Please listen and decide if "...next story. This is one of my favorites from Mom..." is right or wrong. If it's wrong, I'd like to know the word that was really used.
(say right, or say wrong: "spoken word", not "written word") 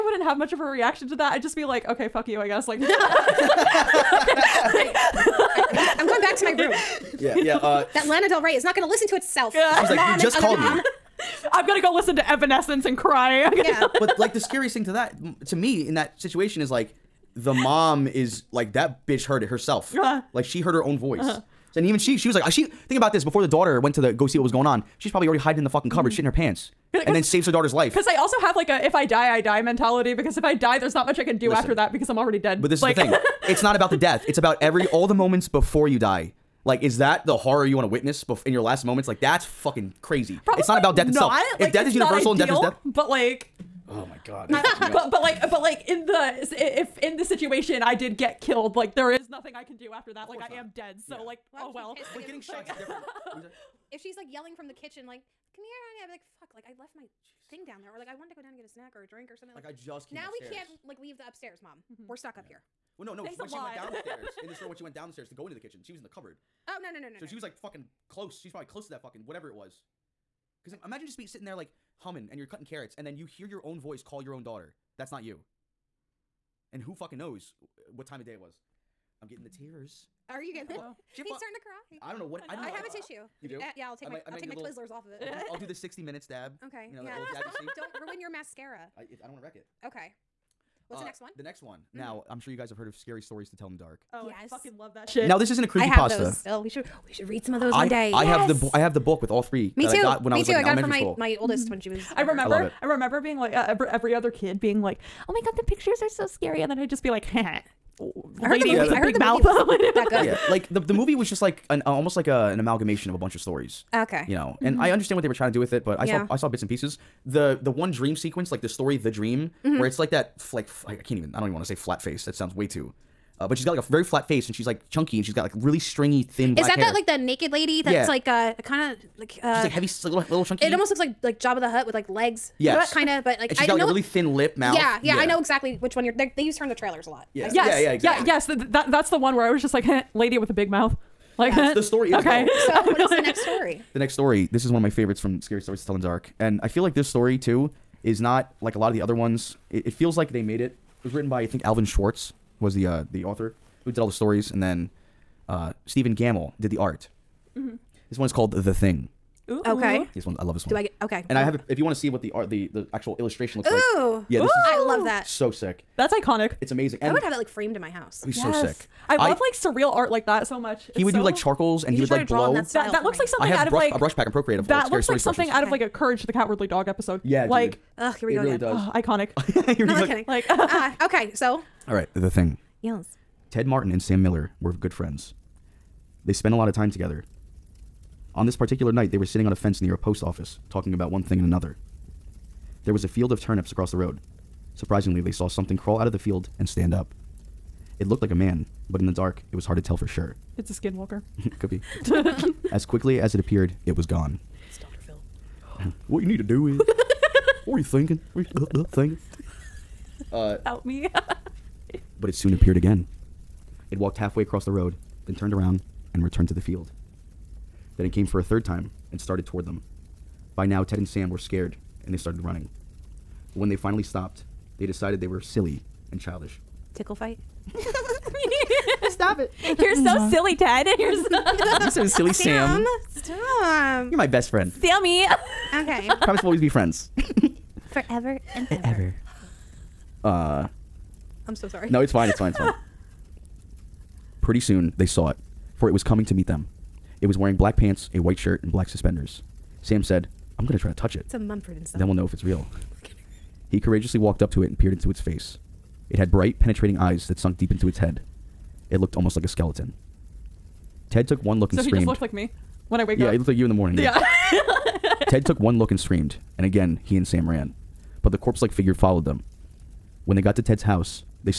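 wrong: "Scary", not "Mom".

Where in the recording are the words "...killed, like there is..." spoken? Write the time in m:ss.
0:48.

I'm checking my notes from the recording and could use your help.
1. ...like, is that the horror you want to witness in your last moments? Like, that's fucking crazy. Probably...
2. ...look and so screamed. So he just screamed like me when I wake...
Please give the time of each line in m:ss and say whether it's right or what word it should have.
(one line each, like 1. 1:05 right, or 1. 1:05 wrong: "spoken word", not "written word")
1. 0:36 right
2. 4:21 wrong: "looked", not "screamed".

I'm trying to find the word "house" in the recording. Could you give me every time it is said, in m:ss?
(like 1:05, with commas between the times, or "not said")
2:47, 4:30.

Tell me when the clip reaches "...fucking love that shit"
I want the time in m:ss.
1:34.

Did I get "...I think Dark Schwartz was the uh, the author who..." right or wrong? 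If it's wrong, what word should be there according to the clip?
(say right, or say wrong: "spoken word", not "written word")
wrong: "Alvin", not "Dark".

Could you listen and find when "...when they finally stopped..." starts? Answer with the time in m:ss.
3:43.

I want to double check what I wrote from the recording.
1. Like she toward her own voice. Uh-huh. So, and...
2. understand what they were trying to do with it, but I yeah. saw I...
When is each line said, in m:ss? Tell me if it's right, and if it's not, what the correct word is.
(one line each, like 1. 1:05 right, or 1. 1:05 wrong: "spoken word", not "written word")
1. 0:20 wrong: "heard", not "toward"
2. 1:54 right.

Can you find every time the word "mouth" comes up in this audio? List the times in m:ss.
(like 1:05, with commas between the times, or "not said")
1:49, 2:14, 2:20.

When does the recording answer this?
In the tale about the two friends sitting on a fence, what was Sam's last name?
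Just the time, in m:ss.
3:04.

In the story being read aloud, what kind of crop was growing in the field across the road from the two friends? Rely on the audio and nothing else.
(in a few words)
Turnips.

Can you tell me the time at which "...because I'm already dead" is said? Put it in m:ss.
0:31.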